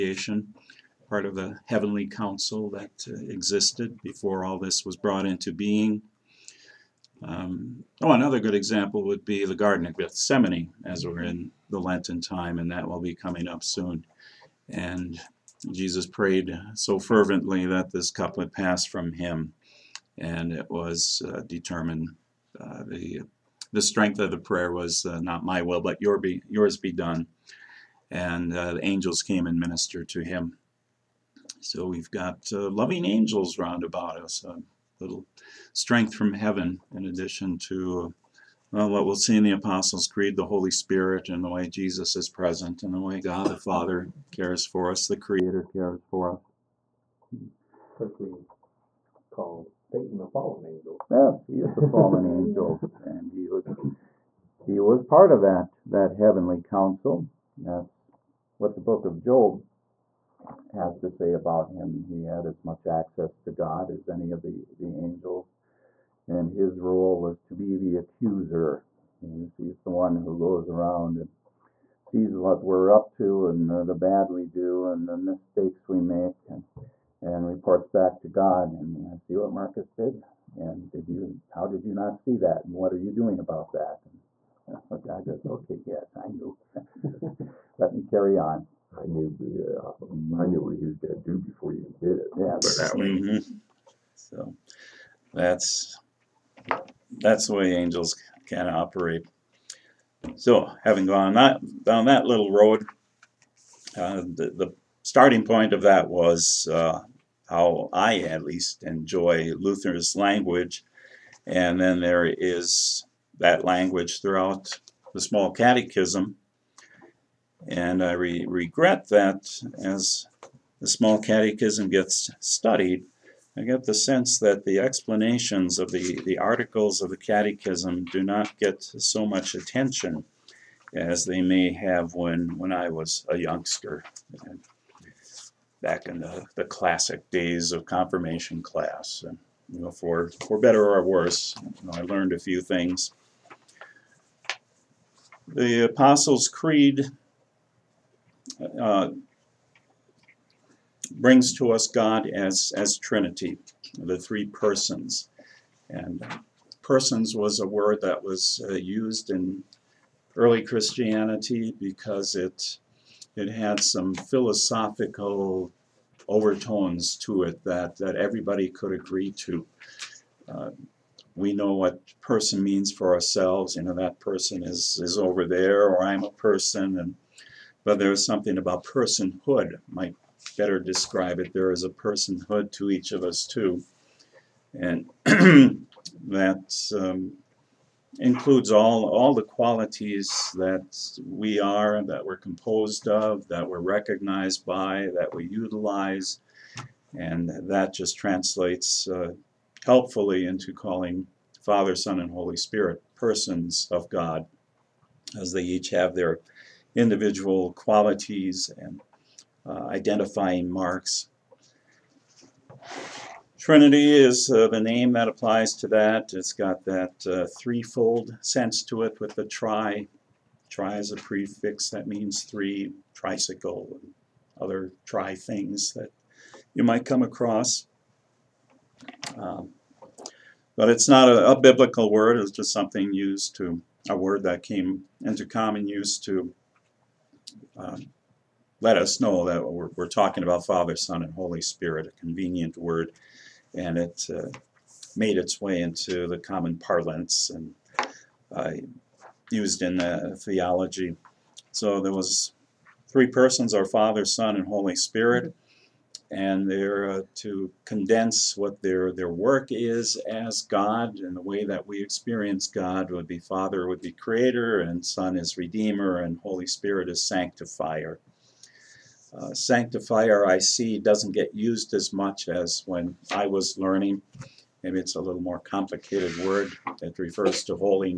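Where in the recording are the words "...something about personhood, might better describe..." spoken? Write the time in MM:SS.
02:58.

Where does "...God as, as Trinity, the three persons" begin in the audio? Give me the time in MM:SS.
02:31.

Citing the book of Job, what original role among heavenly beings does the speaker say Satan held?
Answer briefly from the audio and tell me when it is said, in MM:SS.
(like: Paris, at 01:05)
the accuser, at 01:07.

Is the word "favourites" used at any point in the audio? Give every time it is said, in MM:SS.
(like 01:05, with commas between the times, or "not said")
not said.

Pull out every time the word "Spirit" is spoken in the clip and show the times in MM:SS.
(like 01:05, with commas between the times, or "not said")
00:40, 03:22, 04:01, 04:14, 04:26.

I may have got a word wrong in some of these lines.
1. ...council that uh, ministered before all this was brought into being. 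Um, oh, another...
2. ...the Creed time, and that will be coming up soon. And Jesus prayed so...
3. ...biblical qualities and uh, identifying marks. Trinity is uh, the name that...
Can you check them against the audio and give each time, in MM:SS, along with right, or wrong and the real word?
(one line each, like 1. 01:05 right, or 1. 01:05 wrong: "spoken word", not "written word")
1. 00:02 wrong: "existed", not "ministered"
2. 00:11 wrong: "Lenten", not "Creed"
3. 03:26 wrong: "individual", not "biblical".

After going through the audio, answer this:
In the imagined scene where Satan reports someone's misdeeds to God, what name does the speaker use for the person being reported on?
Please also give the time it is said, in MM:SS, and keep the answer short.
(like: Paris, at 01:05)
Marcus, at 01:19.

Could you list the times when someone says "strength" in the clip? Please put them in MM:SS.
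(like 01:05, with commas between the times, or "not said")
00:23, 00:35.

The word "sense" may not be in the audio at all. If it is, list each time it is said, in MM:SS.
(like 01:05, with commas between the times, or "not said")
02:03, 03:38.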